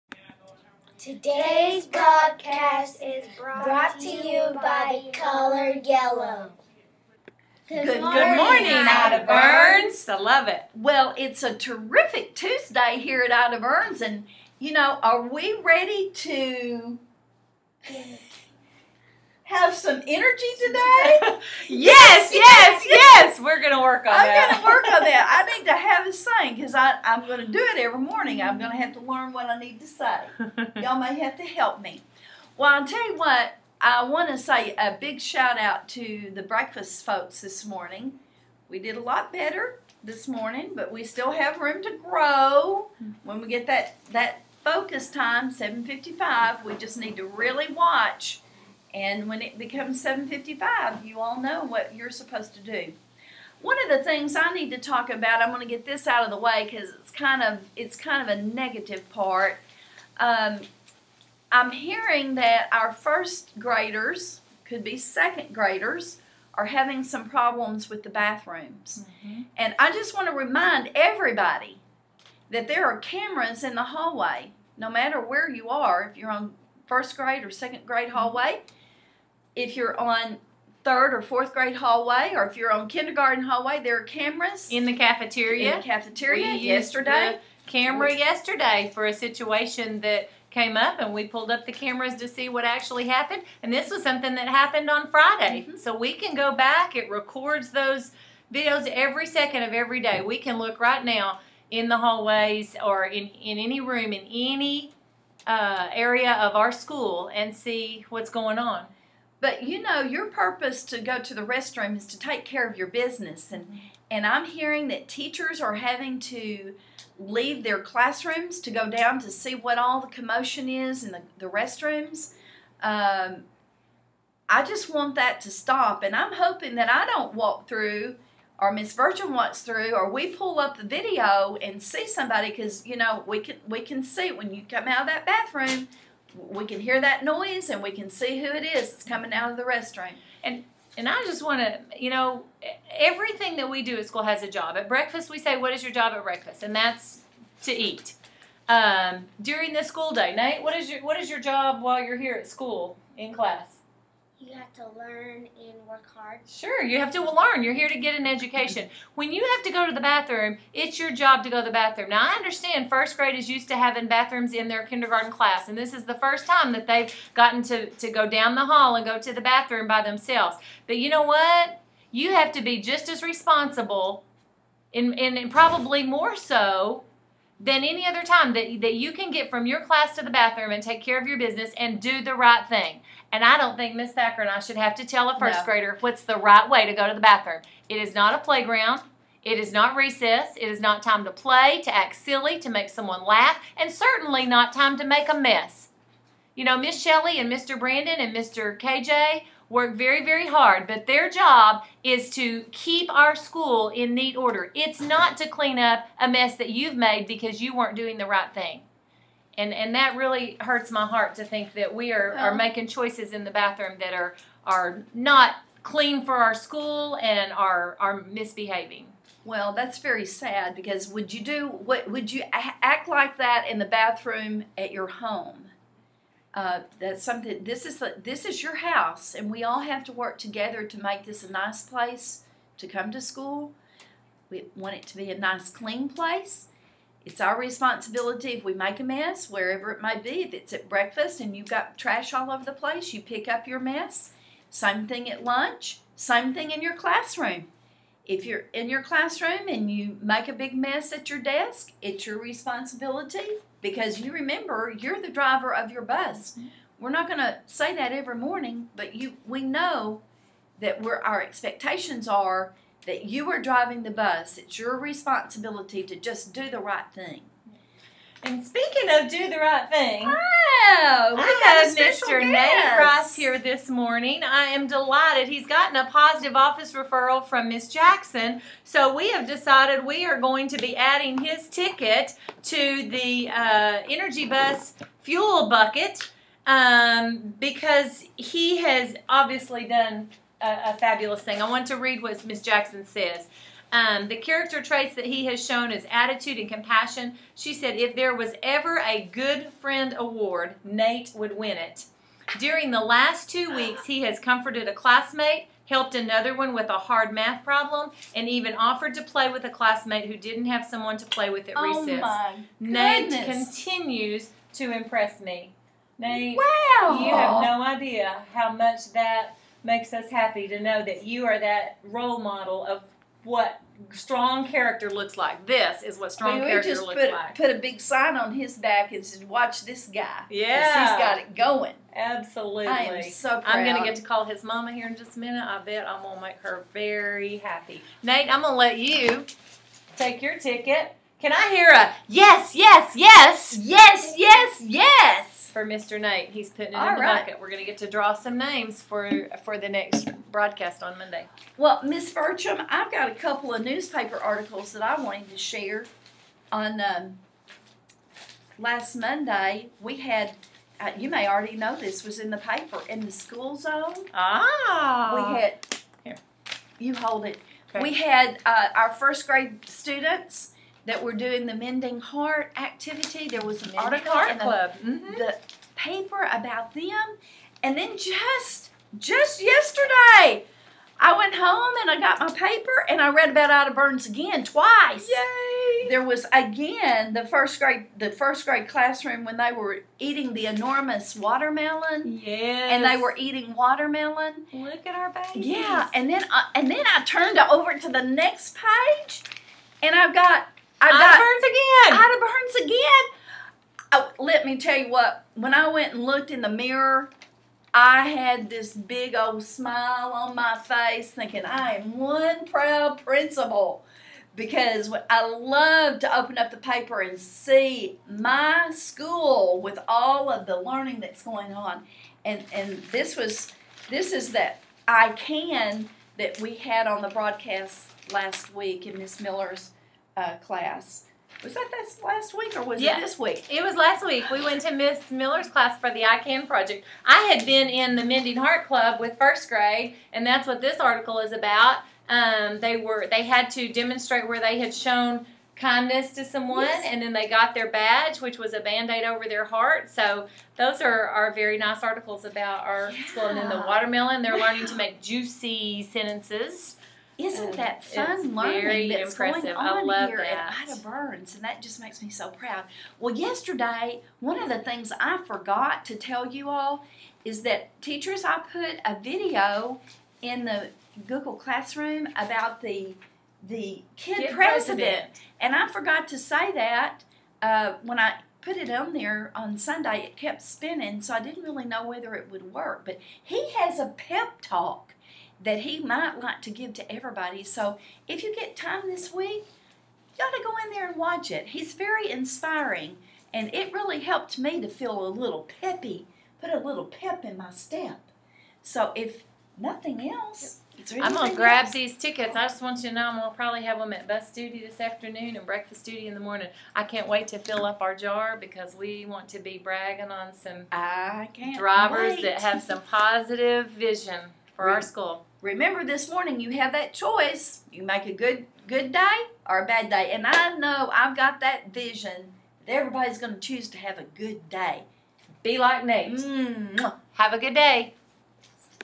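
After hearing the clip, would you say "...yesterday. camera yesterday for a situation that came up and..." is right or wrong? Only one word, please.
right.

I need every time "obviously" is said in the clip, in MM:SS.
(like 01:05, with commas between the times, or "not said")
04:49.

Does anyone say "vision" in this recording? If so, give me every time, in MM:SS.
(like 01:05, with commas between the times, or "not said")
08:33, 08:41.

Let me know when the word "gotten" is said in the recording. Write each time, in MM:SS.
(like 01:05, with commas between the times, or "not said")
02:47, 04:35.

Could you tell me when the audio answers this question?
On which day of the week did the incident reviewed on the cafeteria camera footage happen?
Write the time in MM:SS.
01:35.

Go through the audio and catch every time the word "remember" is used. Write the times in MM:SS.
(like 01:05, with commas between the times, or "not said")
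04:14, 08:35.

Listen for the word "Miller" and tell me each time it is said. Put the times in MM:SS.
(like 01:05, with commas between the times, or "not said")
07:09, 07:15.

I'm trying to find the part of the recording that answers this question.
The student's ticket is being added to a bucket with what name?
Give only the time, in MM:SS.
04:44.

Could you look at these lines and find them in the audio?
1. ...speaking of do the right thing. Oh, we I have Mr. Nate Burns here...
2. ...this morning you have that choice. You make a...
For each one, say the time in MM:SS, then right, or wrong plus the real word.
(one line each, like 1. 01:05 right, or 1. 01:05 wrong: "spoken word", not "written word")
1. 04:28 wrong: "Ross", not "Burns"
2. 08:36 right.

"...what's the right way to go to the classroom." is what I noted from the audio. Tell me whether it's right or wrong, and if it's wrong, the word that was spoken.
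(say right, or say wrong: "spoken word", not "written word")
wrong: "bathroom", not "classroom".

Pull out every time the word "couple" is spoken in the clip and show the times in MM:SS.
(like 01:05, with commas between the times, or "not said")
05:53.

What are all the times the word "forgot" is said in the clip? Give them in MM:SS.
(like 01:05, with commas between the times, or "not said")
07:45, 07:55.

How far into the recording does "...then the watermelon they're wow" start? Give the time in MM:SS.
07:33.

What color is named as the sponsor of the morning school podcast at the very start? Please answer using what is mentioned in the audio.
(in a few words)
yellow.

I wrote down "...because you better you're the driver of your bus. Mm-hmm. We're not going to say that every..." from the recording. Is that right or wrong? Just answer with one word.
wrong.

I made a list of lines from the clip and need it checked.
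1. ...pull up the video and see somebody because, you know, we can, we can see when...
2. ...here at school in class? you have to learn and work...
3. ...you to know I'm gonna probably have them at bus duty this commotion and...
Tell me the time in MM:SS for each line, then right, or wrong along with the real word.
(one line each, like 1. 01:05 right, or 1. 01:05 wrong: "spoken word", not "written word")
1. 02:10 right
2. 02:32 right
3. 08:23 wrong: "afternoon", not "commotion".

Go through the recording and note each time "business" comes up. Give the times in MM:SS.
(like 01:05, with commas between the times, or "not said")
01:52, 03:01.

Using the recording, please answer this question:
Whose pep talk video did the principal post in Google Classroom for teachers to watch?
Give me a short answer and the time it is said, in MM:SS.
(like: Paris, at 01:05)
Kid President, at 07:54.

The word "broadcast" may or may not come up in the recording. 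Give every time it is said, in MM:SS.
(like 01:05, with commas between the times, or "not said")
05:50, 07:07.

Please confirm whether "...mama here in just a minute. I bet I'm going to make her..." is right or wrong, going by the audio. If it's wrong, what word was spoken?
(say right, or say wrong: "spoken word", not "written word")
right.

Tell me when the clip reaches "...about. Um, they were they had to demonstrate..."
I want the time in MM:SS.
07:21.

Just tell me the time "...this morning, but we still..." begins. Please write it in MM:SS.
00:40.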